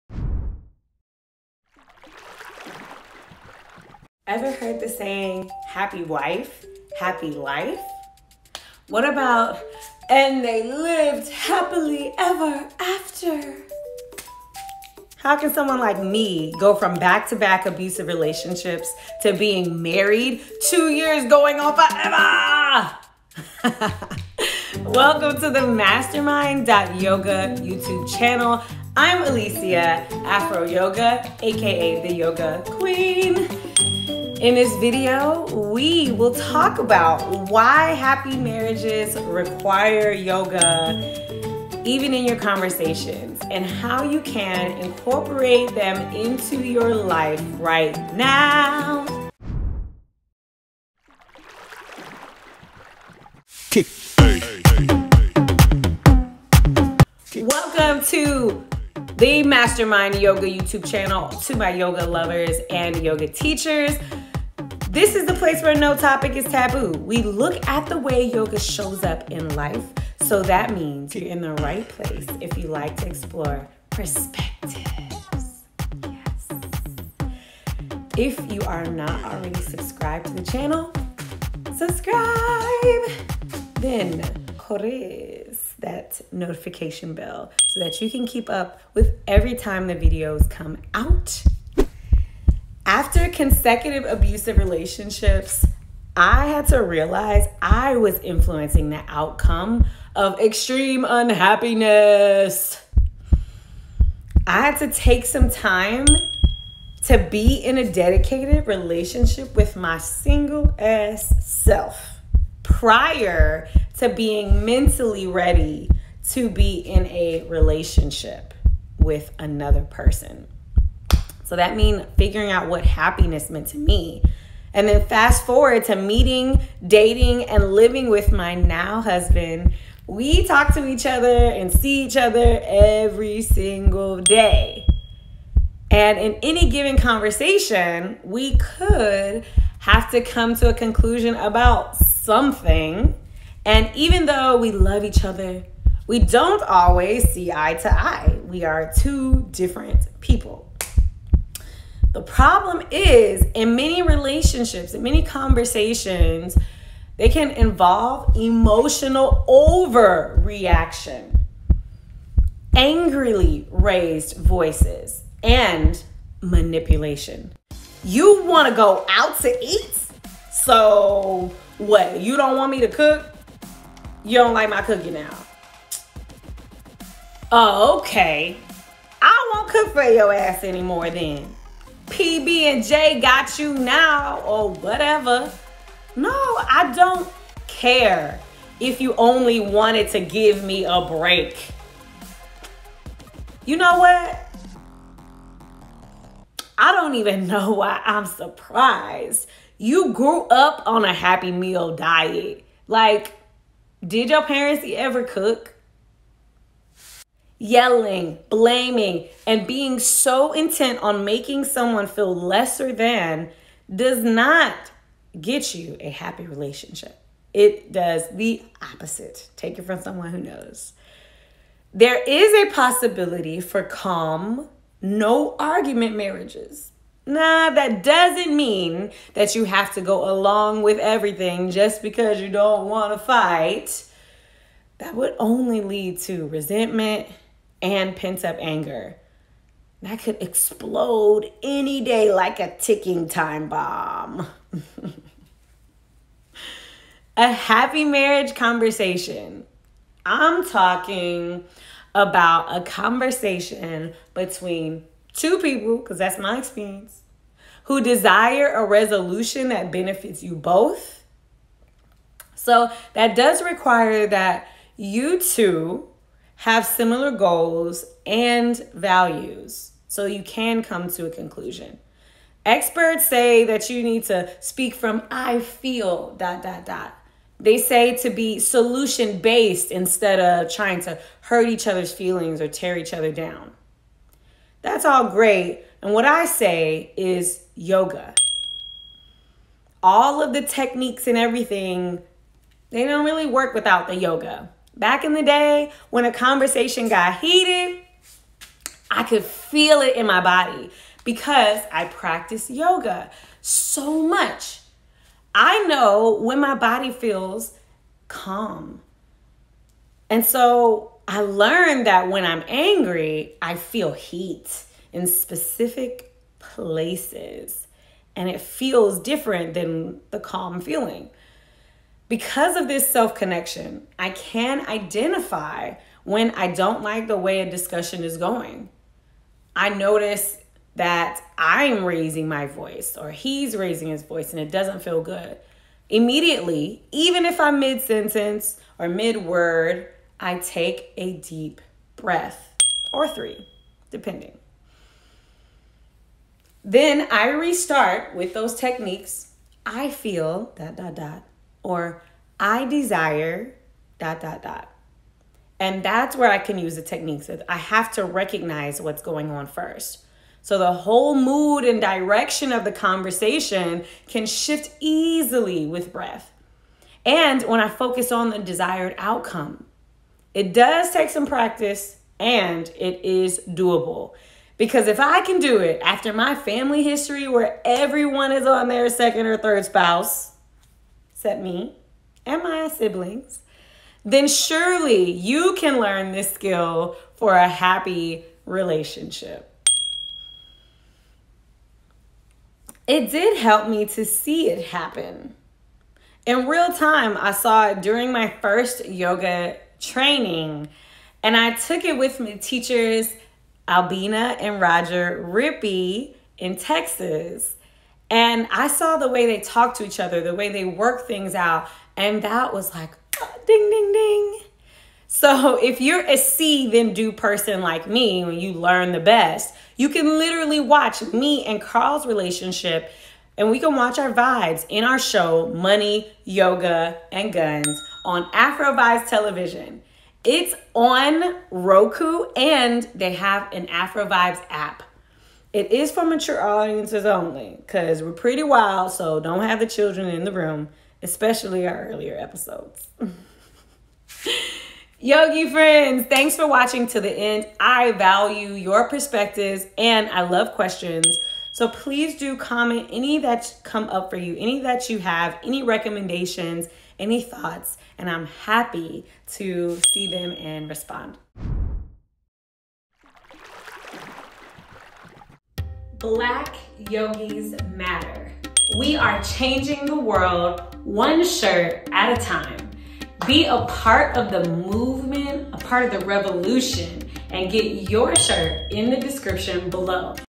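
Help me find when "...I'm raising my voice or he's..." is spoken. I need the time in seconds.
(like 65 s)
331 s.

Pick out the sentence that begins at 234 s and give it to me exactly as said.
That would only lead to resentment and pent up anger that could explode any day like a ticking time bomb.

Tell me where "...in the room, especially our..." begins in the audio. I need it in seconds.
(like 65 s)
440 s.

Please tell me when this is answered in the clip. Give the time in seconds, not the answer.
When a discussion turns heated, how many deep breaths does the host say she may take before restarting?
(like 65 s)
343 s.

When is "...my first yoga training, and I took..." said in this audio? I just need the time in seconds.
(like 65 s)
398 s.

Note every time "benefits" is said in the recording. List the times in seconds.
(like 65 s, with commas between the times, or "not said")
259 s.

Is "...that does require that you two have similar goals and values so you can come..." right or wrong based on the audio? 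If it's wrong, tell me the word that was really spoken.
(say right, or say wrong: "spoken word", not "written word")
right.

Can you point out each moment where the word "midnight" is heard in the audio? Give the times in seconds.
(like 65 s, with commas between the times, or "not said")
not said.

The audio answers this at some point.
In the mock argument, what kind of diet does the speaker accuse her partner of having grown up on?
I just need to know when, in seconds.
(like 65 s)
201 s.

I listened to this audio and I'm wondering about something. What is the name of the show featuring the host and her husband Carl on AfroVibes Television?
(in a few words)
Money, Yoga, and Guns.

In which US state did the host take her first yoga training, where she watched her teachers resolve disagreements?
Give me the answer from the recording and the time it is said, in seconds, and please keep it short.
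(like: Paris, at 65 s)
Texas, at 406 s.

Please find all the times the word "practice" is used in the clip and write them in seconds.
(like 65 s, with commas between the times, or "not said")
302 s, 371 s.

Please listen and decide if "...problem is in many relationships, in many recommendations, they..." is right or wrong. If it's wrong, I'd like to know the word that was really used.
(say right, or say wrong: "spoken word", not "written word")
wrong: "conversations", not "recommendations".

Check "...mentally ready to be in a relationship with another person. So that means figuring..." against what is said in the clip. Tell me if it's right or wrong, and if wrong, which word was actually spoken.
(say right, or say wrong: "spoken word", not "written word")
right.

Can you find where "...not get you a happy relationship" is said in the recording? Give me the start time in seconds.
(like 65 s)
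214 s.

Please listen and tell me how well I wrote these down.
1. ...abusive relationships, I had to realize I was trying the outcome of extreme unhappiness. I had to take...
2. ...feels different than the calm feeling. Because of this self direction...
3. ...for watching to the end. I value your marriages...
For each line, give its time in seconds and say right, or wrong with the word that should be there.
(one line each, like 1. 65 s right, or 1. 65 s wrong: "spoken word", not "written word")
1. 94 s wrong: "influencing", not "trying"
2. 318 s wrong: "connection", not "direction"
3. 446 s wrong: "perspectives", not "marriages".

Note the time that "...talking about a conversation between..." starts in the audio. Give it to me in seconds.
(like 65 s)
250 s.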